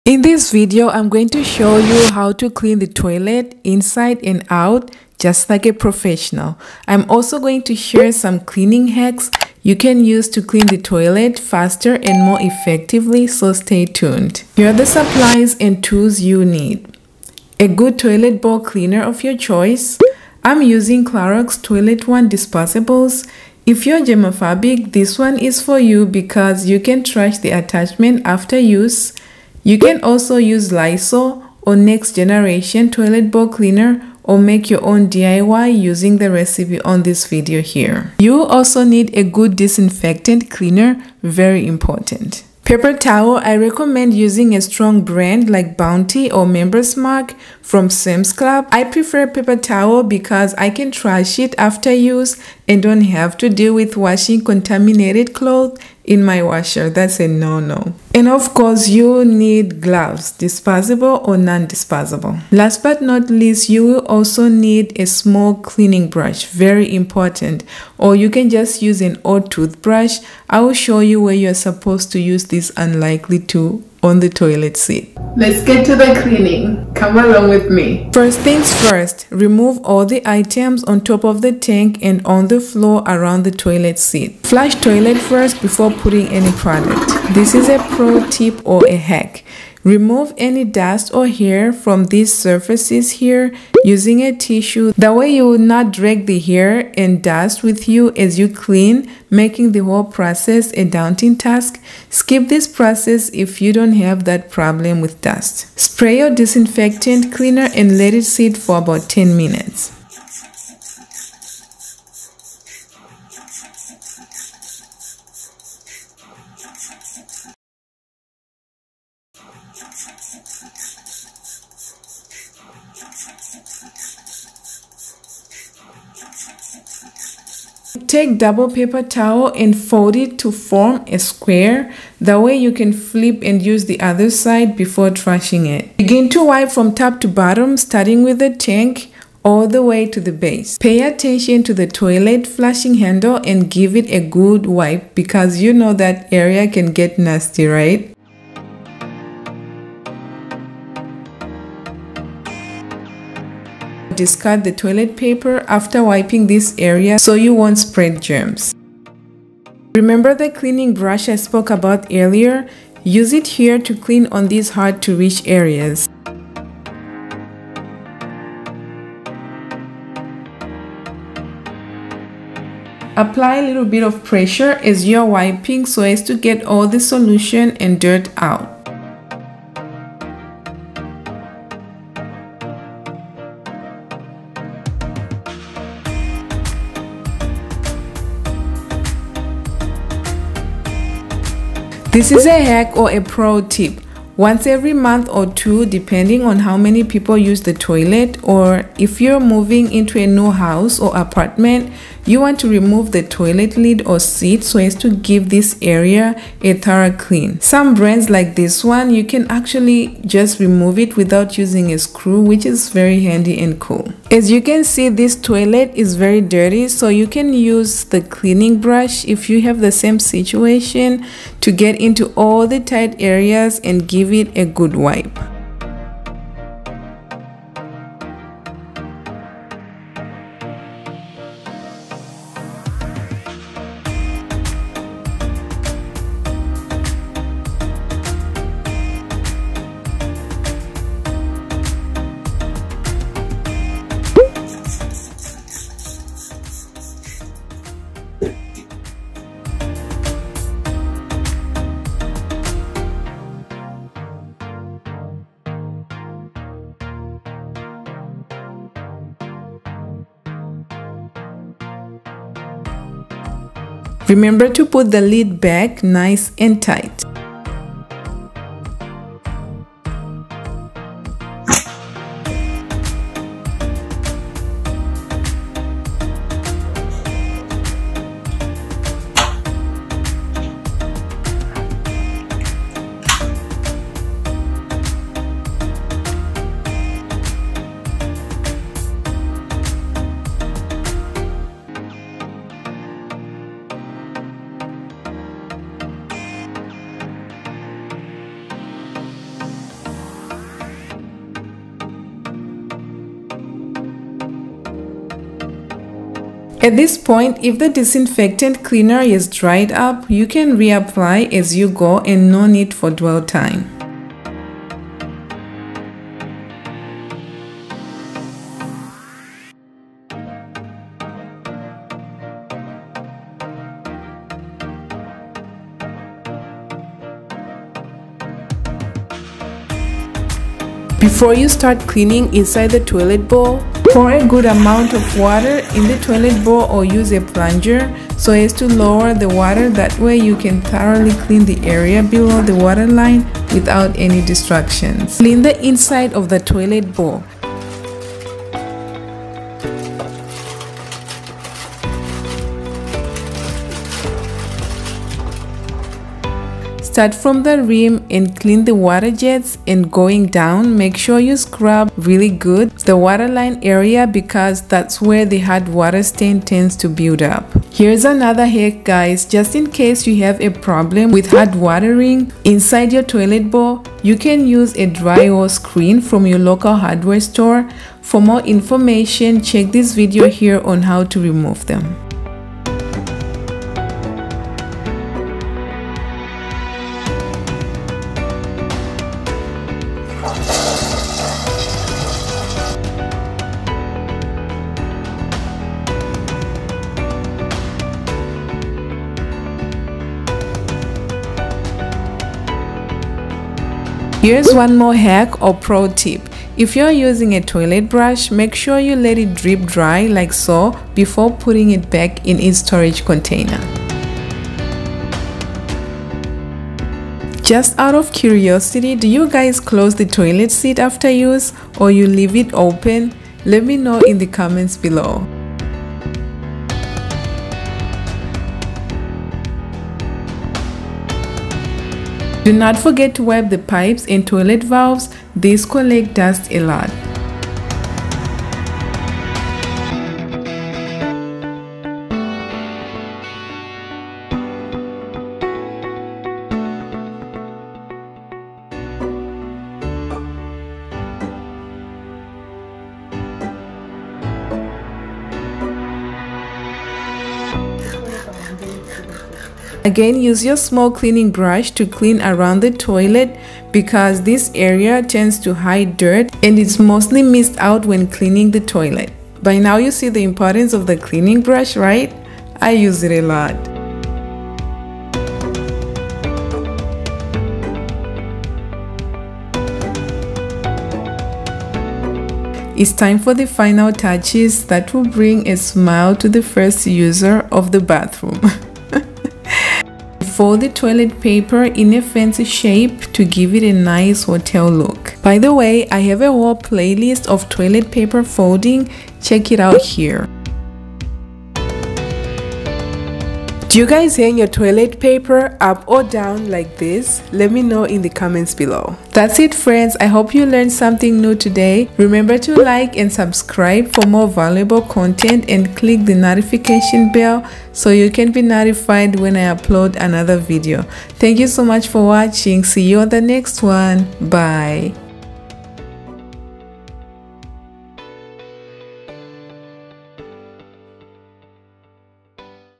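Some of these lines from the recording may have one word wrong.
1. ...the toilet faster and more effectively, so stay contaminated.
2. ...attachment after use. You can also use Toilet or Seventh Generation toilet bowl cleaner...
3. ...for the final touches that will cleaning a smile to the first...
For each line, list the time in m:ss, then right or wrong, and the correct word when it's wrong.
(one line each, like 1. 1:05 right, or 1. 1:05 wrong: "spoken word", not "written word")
1. 0:10 wrong: "tuned", not "contaminated"
2. 0:27 wrong: "Lysol", not "Toilet"
3. 8:03 wrong: "bring", not "cleaning".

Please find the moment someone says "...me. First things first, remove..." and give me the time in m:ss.
1:17.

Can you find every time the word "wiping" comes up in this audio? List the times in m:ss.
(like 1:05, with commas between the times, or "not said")
2:36, 2:55.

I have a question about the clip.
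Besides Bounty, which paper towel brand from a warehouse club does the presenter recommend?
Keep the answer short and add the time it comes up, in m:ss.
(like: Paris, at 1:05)
Member's Mark, at 0:46.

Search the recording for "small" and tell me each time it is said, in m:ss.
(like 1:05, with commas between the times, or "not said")
1:05, 7:40.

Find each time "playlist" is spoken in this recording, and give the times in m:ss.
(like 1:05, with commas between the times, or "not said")
8:16.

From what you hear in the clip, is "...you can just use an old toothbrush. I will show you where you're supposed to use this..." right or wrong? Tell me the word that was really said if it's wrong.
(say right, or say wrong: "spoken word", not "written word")
right.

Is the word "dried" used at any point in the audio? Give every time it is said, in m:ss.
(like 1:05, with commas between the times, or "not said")
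5:09.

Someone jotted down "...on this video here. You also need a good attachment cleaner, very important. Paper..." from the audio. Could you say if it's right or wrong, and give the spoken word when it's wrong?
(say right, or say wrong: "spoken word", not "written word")
wrong: "disinfectant", not "attachment".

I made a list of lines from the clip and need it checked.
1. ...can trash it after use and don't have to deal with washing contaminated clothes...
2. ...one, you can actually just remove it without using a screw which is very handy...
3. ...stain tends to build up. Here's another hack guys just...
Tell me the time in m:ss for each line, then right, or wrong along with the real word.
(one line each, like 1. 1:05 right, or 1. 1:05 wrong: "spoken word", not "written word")
1. 0:50 right
2. 3:28 right
3. 6:06 right.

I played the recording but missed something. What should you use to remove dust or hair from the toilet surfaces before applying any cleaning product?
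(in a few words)
A tissue.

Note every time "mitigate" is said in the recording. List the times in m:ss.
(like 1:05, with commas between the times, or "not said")
not said.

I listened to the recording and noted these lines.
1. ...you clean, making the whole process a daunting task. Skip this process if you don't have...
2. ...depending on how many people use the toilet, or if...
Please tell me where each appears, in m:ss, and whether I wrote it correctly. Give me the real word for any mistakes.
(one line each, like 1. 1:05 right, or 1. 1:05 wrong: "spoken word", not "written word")
1. 1:38 right
2. 3:15 right.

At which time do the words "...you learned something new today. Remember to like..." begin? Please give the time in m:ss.
8:30.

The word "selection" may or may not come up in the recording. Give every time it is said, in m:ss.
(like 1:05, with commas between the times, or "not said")
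not said.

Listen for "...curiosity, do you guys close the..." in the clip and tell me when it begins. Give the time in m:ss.
6:58.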